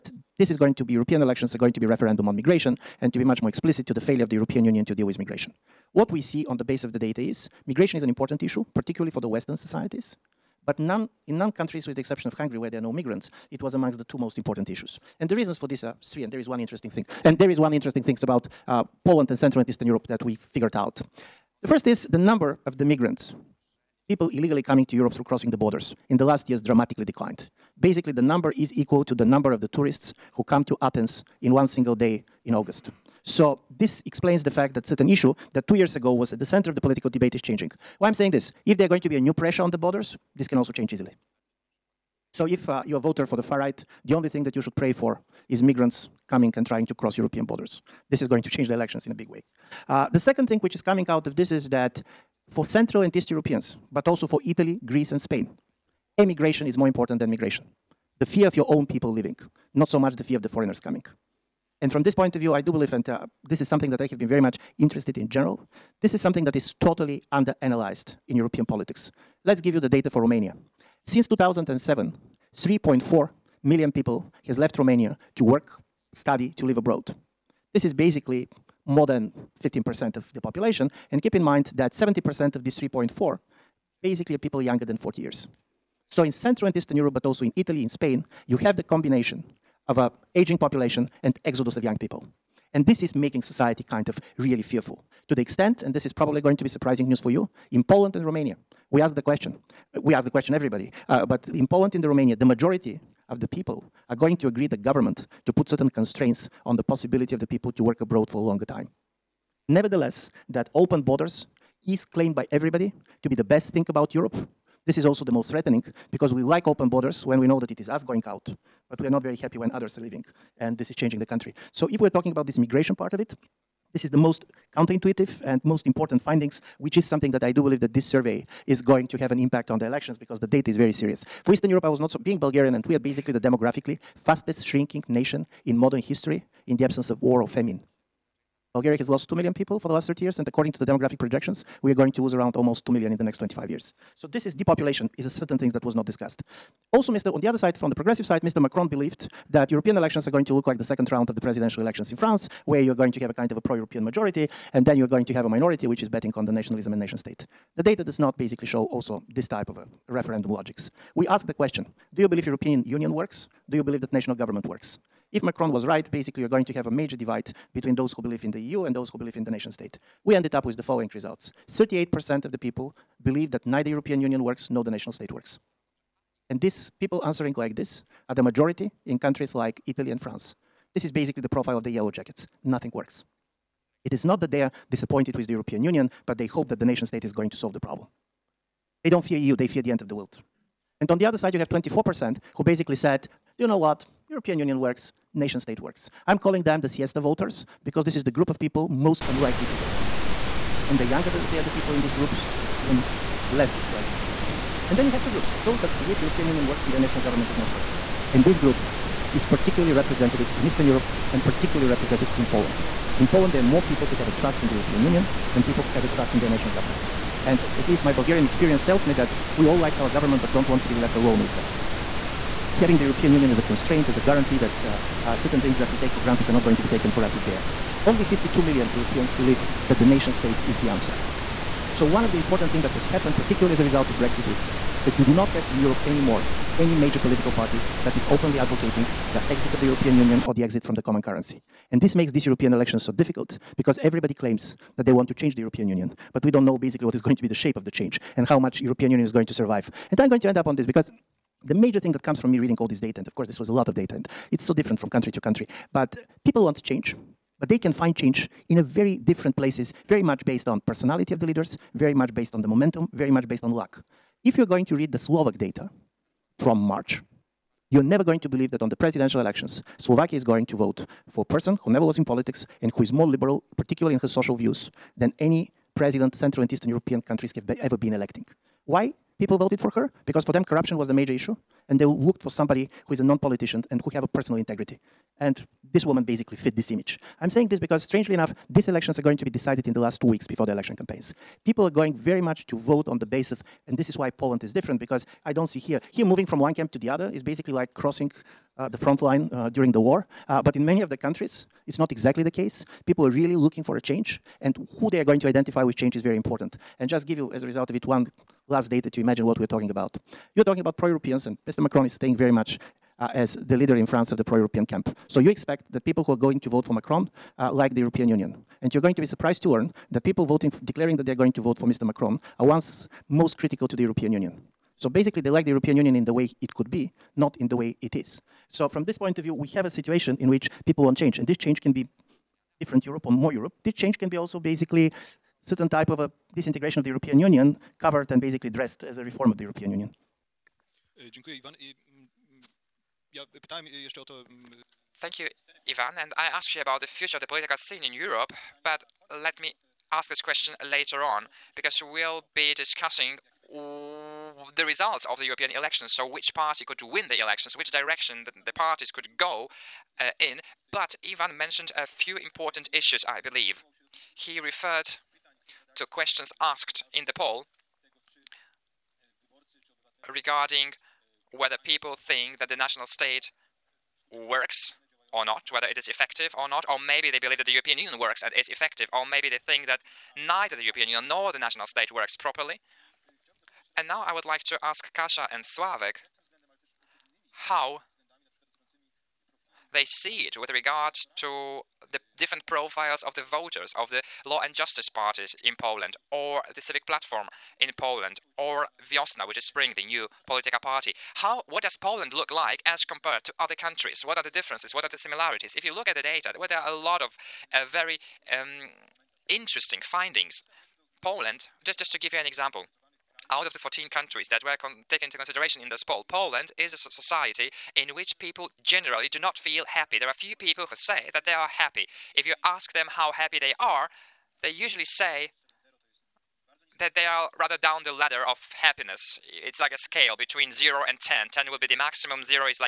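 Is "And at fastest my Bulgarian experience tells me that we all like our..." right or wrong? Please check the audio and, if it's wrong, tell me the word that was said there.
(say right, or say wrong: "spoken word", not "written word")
wrong: "least", not "fastest".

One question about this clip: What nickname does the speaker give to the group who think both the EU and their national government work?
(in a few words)
siesta voters.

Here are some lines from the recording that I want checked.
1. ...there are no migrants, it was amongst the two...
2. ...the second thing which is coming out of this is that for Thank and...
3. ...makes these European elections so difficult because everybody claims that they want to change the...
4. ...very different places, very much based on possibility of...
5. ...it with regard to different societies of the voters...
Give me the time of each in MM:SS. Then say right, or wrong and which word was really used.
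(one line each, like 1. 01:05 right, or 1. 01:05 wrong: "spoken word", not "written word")
1. 00:12 right
2. 00:50 wrong: "Central", not "Thank"
3. 04:02 right
4. 04:18 wrong: "personality", not "possibility"
5. 06:30 wrong: "profiles", not "societies".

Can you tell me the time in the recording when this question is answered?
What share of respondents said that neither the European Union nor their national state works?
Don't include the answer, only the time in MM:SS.
02:51.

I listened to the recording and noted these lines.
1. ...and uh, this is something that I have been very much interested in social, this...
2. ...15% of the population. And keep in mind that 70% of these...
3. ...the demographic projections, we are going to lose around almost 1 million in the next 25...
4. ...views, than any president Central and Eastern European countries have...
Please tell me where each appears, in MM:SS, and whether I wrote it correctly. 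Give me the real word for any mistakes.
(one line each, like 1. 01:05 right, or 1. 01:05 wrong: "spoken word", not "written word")
1. 01:02 wrong: "general", not "social"
2. 01:19 right
3. 02:20 wrong: "2", not "1"
4. 04:34 right.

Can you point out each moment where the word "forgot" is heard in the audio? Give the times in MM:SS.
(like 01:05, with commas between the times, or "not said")
not said.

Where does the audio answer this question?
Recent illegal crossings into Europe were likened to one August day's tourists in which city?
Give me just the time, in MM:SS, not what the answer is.
00:30.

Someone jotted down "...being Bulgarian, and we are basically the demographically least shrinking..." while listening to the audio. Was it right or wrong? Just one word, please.
wrong.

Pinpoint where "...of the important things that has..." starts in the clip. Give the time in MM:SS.
03:52.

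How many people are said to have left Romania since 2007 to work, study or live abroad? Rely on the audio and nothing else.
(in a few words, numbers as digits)
3.4 million.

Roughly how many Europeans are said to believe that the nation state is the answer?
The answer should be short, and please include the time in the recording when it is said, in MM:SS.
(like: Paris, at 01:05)
52 million, at 03:48.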